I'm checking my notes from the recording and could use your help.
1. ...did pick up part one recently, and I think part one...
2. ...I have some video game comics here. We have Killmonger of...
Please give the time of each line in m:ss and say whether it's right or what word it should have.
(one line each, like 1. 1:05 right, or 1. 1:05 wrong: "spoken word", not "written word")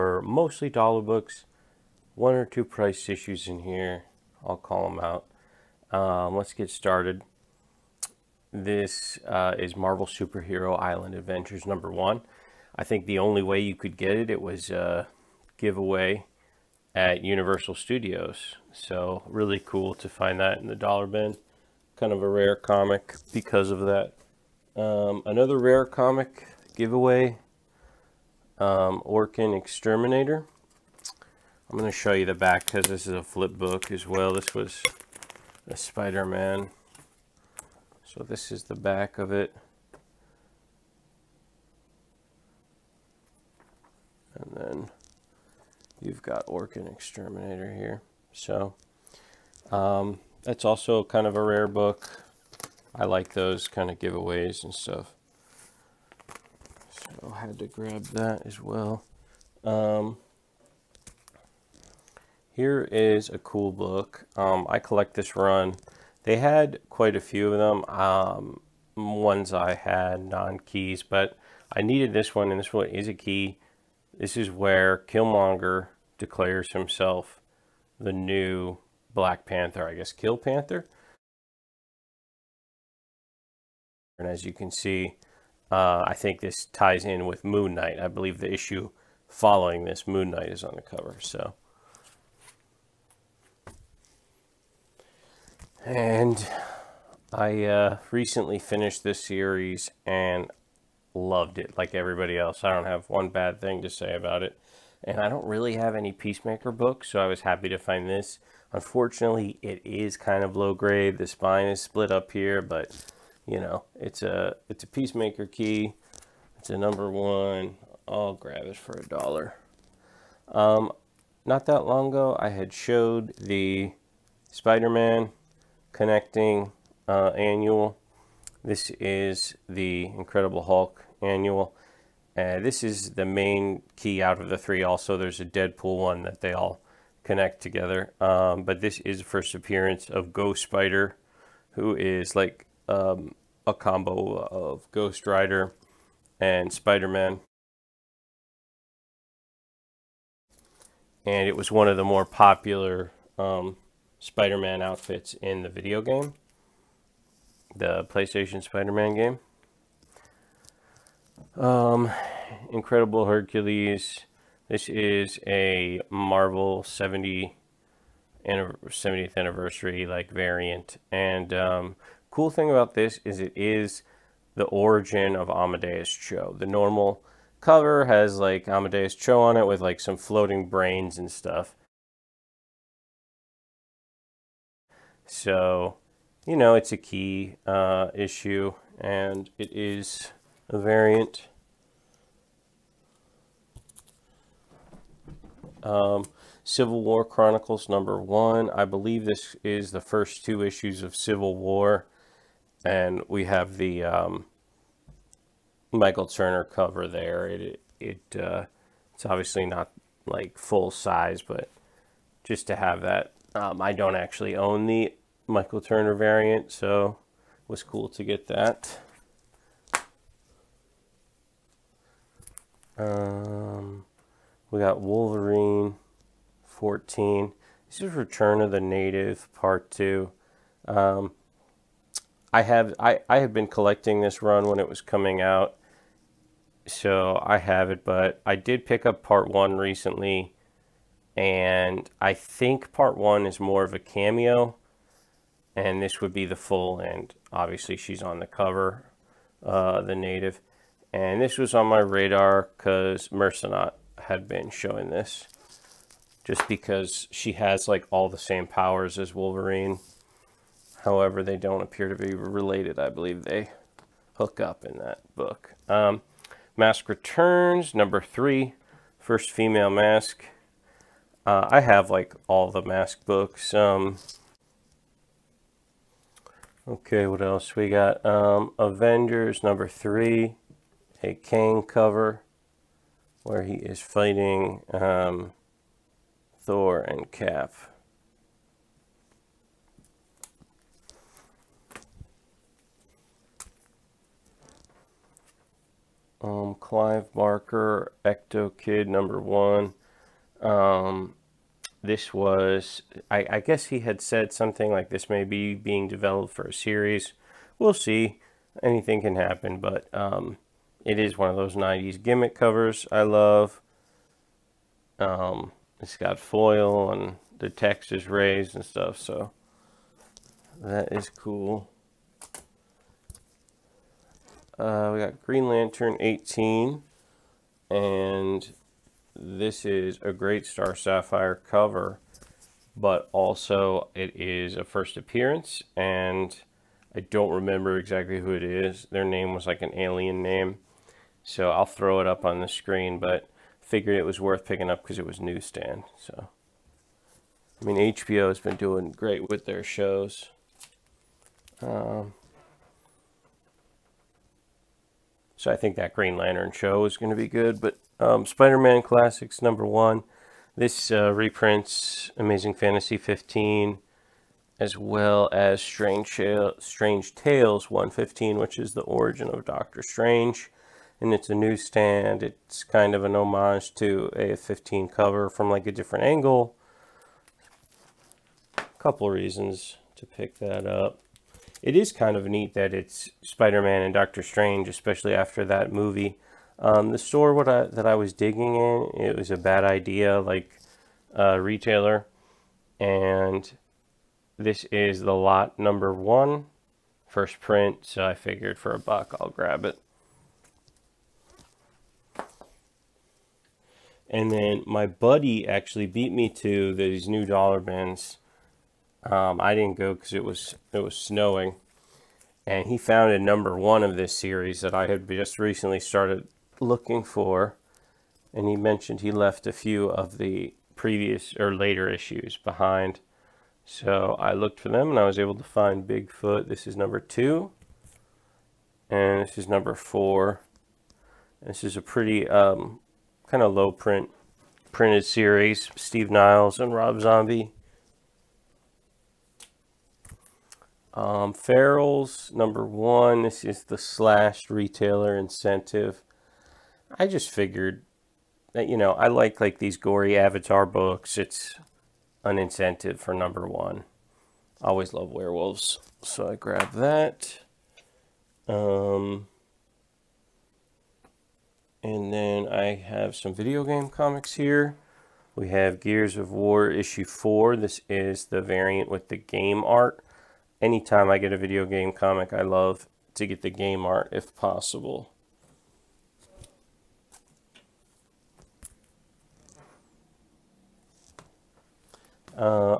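1. 3:58 right
2. 7:42 wrong: "Gears", not "Killmonger".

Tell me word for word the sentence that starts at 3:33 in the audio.
Um, I don't actually own the Michael Turner variant, so it was cool to get that.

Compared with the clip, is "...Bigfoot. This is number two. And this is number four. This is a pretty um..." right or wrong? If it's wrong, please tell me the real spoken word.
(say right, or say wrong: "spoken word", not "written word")
right.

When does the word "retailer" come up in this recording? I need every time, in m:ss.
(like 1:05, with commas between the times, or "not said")
6:31, 7:24.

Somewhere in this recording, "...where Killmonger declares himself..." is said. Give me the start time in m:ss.
1:14.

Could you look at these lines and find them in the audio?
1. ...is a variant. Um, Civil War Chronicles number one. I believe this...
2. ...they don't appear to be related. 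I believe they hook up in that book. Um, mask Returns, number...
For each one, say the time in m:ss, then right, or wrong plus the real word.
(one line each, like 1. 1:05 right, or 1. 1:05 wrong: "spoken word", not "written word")
1. 3:09 right
2. 4:21 right.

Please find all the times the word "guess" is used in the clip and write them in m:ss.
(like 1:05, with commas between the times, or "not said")
1:19, 5:03.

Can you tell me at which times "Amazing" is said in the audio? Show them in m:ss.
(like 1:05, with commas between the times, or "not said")
6:02.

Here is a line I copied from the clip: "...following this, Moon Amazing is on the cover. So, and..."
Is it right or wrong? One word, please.
wrong.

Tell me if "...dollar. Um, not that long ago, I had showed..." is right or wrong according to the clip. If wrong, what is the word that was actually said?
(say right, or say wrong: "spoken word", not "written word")
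right.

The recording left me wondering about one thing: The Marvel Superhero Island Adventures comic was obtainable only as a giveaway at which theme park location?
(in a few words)
Universal Studios.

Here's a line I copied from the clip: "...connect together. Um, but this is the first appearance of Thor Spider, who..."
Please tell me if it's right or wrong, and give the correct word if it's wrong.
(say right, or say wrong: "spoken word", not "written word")
wrong: "Ghost", not "Thor".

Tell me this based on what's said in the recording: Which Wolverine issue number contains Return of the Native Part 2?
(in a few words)
14.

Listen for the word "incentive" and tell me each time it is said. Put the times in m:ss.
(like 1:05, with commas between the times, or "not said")
7:25, 7:32.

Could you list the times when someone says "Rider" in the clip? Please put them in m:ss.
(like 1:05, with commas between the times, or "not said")
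2:25.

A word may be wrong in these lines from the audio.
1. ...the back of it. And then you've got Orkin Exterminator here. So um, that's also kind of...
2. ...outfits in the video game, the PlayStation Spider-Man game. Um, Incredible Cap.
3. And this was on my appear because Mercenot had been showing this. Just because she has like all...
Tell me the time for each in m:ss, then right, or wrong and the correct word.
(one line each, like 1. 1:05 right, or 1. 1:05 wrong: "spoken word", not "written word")
1. 0:38 right
2. 2:34 wrong: "Hercules", not "Cap"
3. 4:11 wrong: "radar", not "appear".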